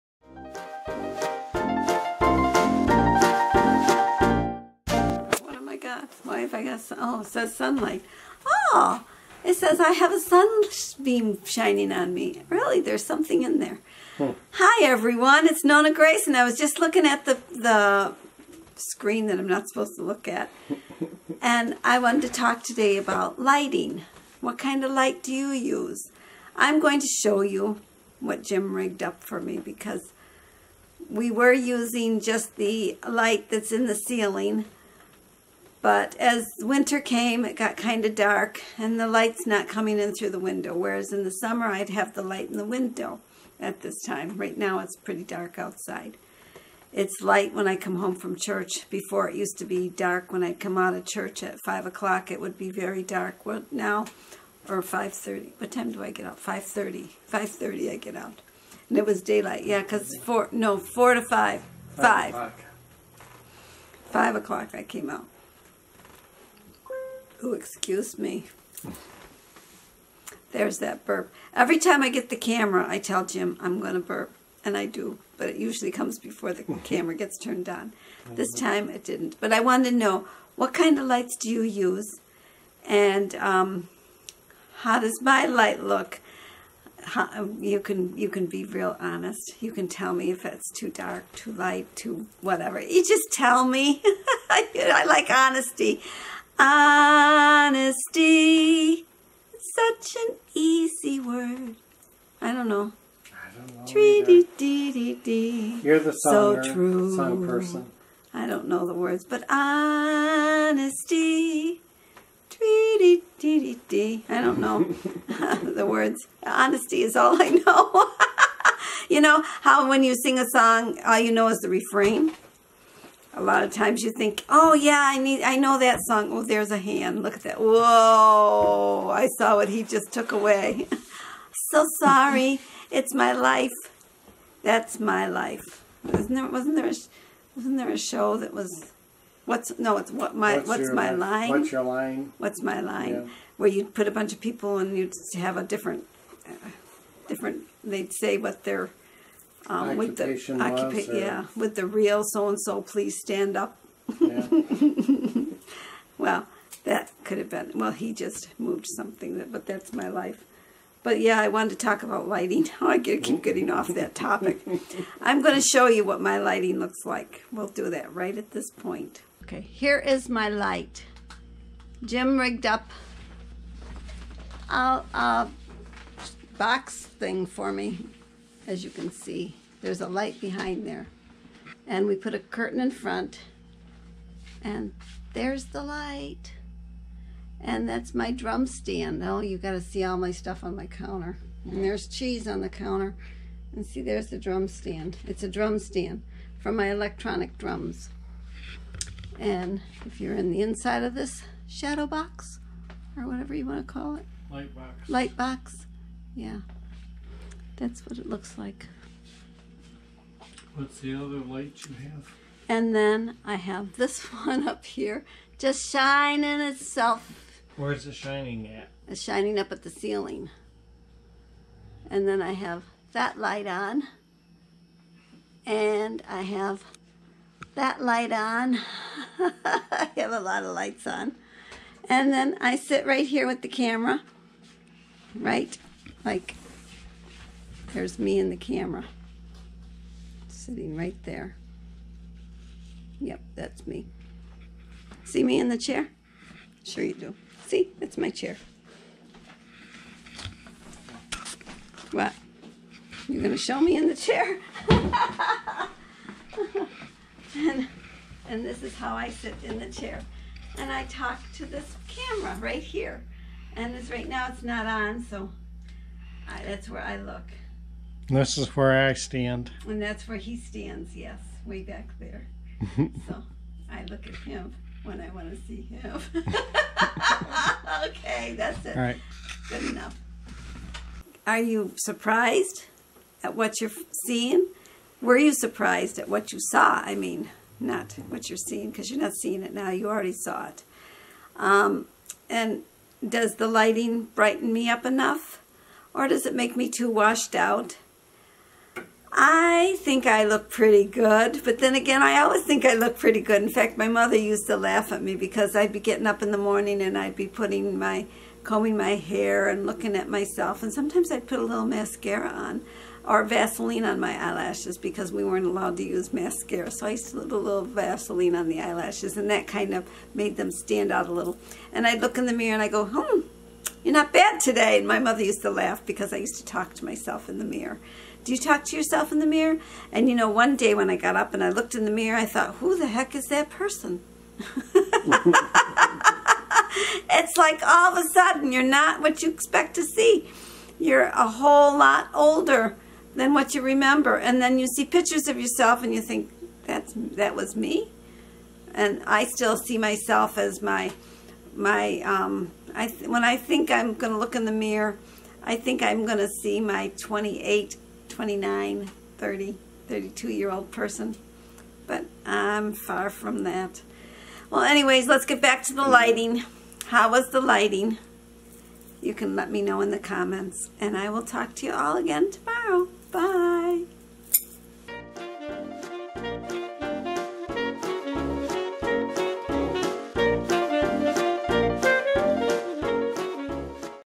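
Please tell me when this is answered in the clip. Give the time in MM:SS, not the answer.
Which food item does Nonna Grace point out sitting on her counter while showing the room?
03:12.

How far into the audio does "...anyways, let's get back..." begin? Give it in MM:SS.
06:04.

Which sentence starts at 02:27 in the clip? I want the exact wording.
They'd say what they're um, with the yeah, with the real so and so, please stand up.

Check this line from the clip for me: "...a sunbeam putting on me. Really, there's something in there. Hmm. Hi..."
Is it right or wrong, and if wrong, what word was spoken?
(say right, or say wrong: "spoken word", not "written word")
wrong: "shining", not "putting".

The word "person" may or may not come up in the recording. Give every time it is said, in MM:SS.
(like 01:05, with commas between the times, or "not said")
01:47, 05:33, 06:00.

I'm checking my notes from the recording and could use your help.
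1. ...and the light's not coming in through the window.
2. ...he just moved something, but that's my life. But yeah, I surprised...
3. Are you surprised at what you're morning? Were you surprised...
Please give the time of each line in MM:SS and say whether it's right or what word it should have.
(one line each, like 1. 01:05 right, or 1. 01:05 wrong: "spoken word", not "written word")
1. 00:38 right
2. 02:37 wrong: "wanted", not "surprised"
3. 04:41 wrong: "seeing", not "morning".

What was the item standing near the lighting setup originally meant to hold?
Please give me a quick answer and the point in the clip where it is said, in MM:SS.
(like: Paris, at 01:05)
electronic drums, at 03:16.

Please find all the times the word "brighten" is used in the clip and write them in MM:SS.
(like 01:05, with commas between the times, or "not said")
04:54.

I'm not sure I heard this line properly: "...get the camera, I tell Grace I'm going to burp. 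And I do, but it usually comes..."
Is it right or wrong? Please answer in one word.
wrong.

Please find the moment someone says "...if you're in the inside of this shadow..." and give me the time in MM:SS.
03:20.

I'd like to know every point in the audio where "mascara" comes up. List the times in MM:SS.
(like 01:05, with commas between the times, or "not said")
05:11, 05:16.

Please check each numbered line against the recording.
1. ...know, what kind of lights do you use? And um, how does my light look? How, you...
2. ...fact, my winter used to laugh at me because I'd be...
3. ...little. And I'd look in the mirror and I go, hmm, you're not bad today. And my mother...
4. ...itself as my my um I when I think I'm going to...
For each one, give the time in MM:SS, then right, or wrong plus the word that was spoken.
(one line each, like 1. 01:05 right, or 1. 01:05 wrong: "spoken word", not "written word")
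1. 01:19 right
2. 05:03 wrong: "mother", not "winter"
3. 05:21 right
4. 05:49 wrong: "myself", not "itself".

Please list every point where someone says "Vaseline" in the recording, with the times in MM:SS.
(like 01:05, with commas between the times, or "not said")
05:13, 05:17.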